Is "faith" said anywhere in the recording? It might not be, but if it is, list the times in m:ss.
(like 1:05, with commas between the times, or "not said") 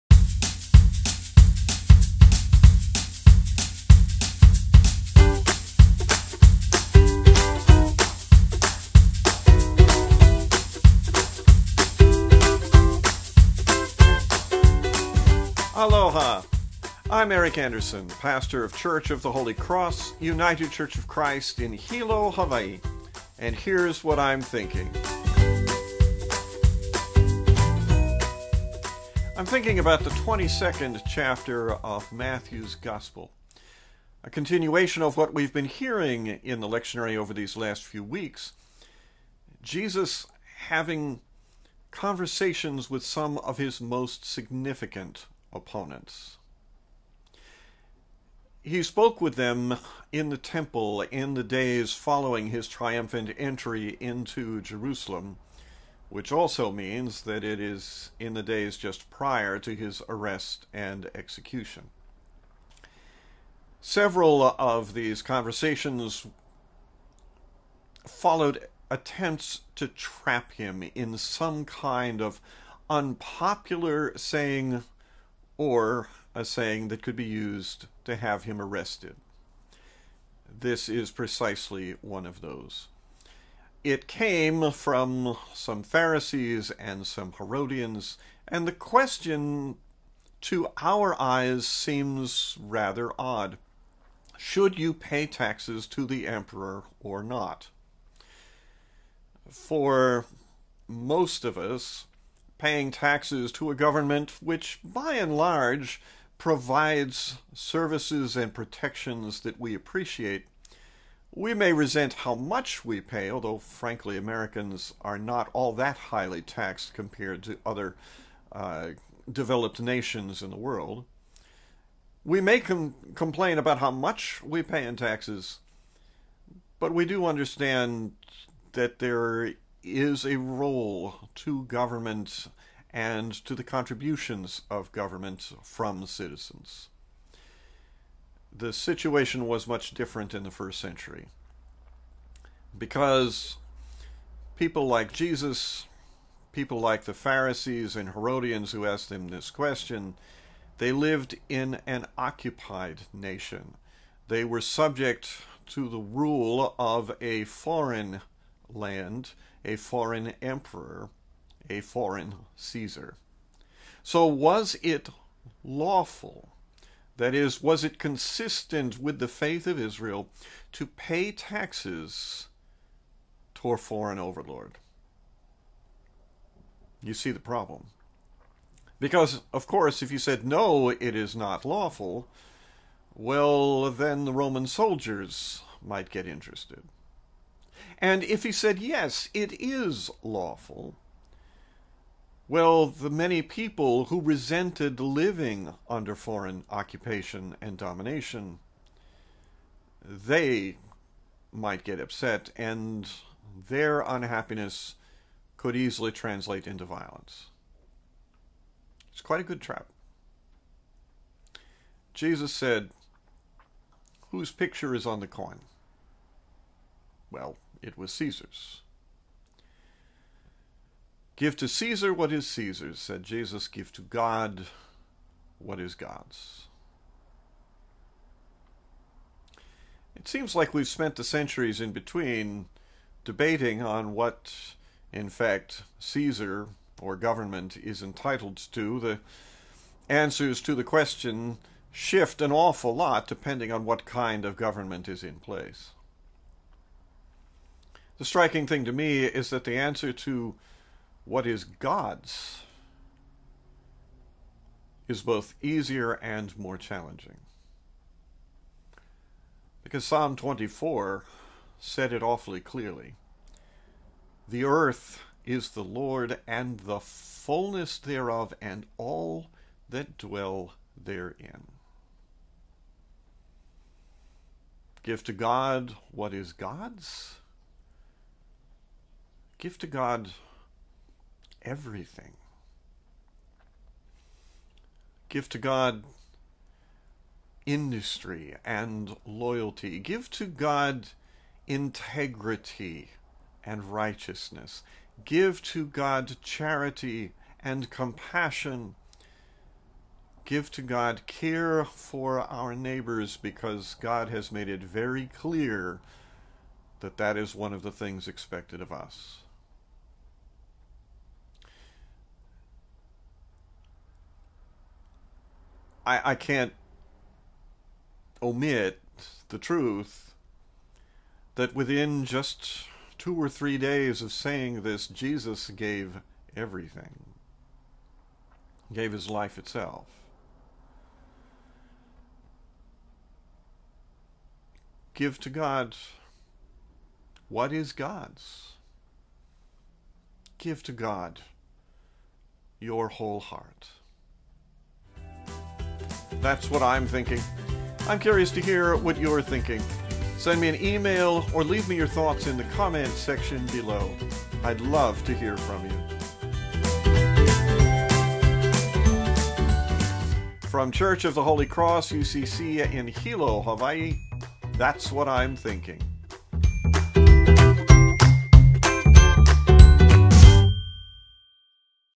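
2:49.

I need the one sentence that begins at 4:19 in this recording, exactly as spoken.
Because Psalm 24 said it awfully clearly The earth is the Lord and the fullness thereof, and all that dwell therein.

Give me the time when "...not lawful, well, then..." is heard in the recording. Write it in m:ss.
3:01.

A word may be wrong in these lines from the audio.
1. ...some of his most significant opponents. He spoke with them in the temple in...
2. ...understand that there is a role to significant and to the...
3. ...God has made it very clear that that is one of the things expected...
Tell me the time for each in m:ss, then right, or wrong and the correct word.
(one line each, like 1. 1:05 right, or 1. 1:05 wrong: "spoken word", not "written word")
1. 0:43 right
2. 2:07 wrong: "government", not "significant"
3. 5:04 right.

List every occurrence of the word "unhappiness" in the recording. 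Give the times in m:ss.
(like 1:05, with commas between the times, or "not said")
3:24.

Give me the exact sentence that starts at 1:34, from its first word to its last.
Should you pay taxes to the emperor or not?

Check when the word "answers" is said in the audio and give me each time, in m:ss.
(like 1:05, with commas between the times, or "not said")
4:00, 4:09.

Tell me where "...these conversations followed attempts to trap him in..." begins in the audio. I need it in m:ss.
1:04.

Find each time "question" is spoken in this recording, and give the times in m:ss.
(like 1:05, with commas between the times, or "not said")
1:28, 2:29, 4:00.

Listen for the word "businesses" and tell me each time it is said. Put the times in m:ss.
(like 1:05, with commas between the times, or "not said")
not said.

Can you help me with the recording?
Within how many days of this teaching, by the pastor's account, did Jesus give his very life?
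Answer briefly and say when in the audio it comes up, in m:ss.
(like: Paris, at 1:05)
2 or 3, at 5:23.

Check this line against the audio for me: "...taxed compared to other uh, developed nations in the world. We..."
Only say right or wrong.
right.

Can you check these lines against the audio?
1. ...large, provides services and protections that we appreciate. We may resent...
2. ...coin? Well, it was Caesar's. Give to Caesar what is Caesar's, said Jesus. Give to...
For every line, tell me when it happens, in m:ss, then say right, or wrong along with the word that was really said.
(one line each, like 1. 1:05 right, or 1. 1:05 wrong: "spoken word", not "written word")
1. 1:45 right
2. 3:35 right.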